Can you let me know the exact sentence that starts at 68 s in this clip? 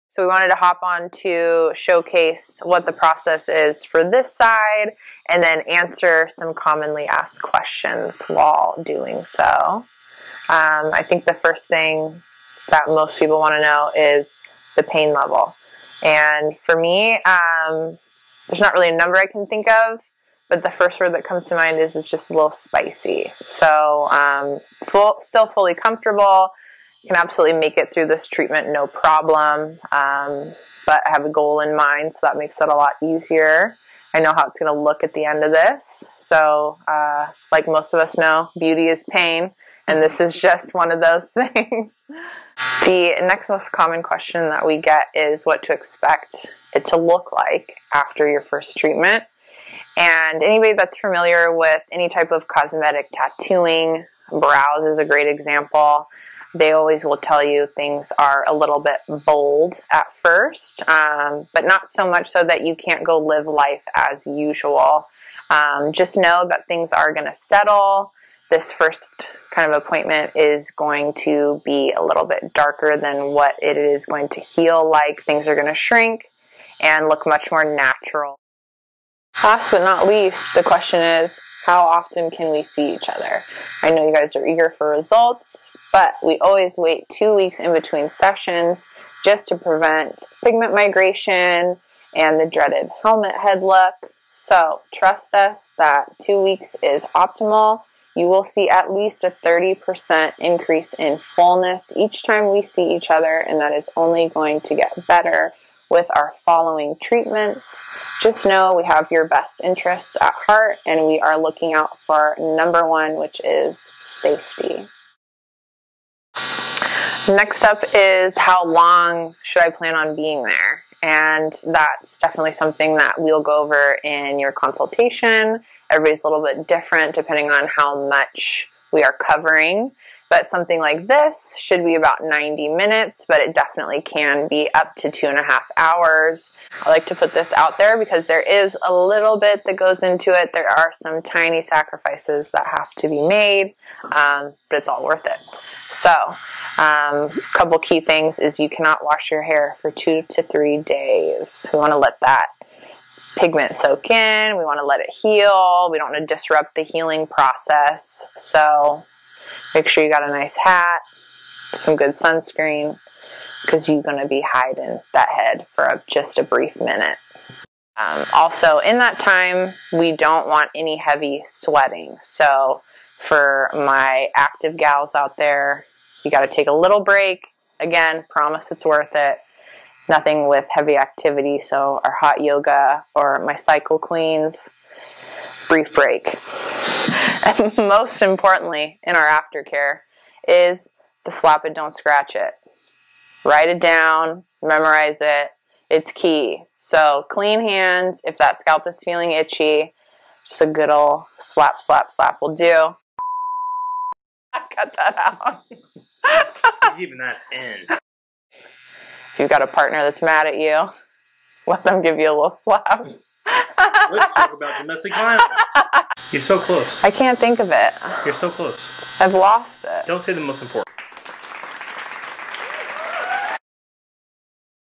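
This first kind of appointment is going to be a little bit darker than what it is going to heal like.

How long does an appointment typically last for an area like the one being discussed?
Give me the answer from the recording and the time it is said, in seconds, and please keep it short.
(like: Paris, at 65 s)
90 minutes, at 132 s.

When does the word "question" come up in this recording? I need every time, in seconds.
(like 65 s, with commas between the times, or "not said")
7 s, 44 s, 80 s.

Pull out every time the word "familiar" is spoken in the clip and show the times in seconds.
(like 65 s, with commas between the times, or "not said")
50 s.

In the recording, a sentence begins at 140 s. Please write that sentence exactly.
There are some tiny sacrifices that have to be made, um, but it's all worth it.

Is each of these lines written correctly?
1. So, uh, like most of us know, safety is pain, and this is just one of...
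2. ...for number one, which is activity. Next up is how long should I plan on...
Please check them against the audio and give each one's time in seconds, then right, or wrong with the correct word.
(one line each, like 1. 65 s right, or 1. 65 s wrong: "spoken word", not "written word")
1. 36 s wrong: "beauty", not "safety"
2. 111 s wrong: "safety", not "activity".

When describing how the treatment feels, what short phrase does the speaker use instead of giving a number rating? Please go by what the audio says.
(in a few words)
a little spicy.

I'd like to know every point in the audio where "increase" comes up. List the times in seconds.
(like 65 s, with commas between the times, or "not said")
100 s.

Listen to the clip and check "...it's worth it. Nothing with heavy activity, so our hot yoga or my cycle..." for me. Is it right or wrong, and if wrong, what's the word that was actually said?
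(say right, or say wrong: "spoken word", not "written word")
right.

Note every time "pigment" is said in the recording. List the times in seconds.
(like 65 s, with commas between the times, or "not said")
90 s, 153 s.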